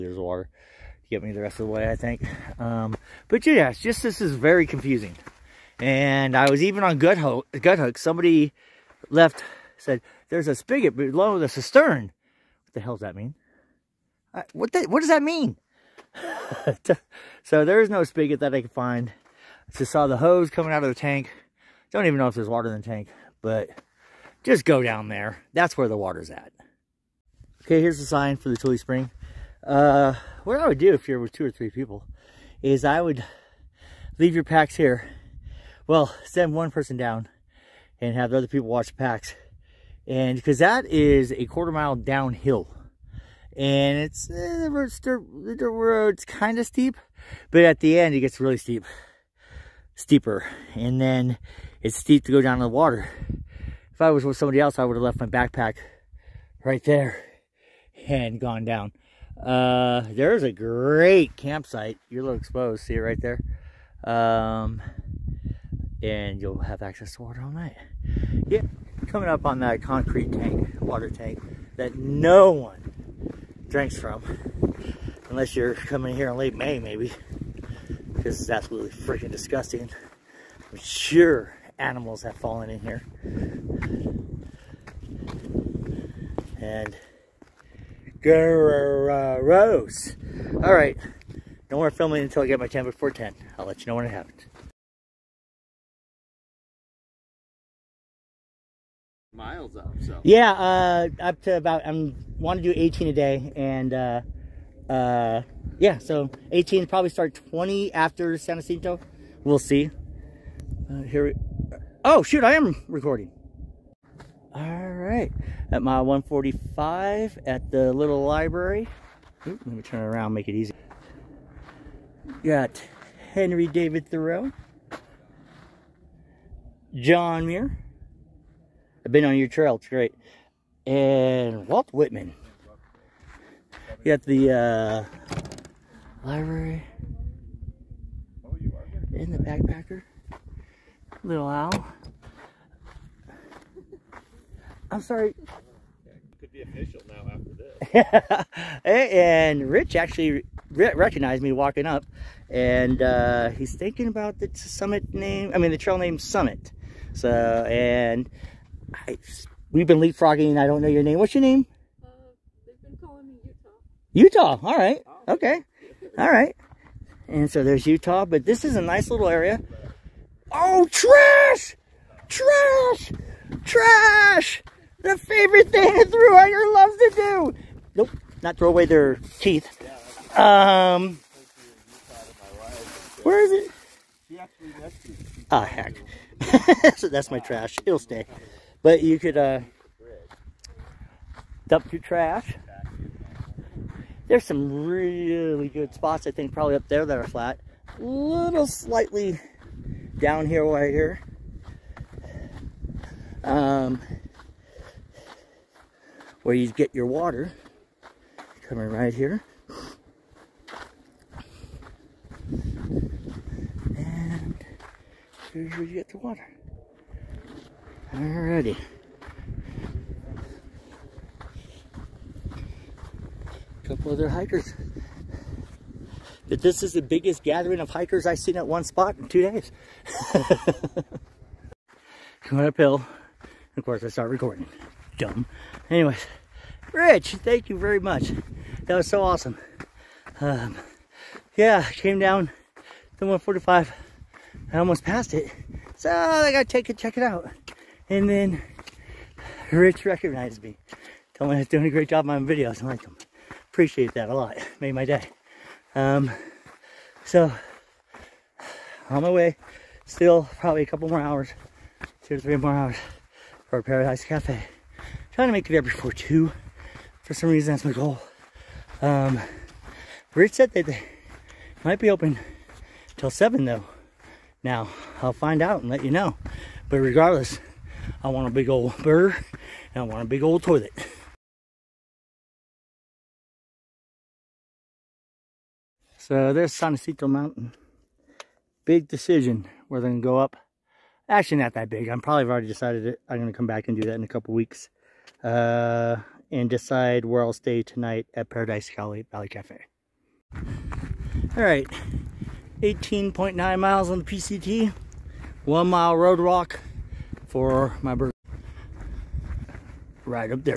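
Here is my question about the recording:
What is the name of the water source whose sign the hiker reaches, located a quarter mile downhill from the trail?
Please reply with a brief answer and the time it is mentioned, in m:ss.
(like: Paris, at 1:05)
Tully Spring, at 0:28.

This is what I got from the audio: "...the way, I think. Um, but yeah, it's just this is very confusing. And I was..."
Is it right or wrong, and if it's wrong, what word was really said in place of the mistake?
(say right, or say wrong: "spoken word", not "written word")
right.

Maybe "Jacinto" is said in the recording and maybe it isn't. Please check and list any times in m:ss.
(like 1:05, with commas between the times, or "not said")
1:48, 4:46.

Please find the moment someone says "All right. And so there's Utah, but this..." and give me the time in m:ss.
2:46.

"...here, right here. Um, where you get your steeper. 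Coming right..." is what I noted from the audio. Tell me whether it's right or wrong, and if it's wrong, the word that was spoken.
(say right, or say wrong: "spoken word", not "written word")
wrong: "water", not "steeper".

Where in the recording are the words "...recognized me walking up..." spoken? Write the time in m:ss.
2:30.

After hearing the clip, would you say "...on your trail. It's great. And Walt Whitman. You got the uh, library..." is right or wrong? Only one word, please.
right.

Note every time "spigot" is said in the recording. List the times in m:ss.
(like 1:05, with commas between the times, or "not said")
0:10, 0:18.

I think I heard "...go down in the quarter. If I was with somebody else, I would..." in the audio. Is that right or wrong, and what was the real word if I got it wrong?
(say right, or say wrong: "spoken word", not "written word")
wrong: "water", not "quarter".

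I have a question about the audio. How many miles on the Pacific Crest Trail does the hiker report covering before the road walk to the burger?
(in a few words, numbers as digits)
18.9.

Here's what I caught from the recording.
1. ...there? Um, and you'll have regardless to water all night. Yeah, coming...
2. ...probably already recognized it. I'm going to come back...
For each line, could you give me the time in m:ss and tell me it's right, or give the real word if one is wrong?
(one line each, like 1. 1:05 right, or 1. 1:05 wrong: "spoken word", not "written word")
1. 1:03 wrong: "access", not "regardless"
2. 4:52 wrong: "decided", not "recognized".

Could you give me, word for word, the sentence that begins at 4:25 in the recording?
trying to make it there before two.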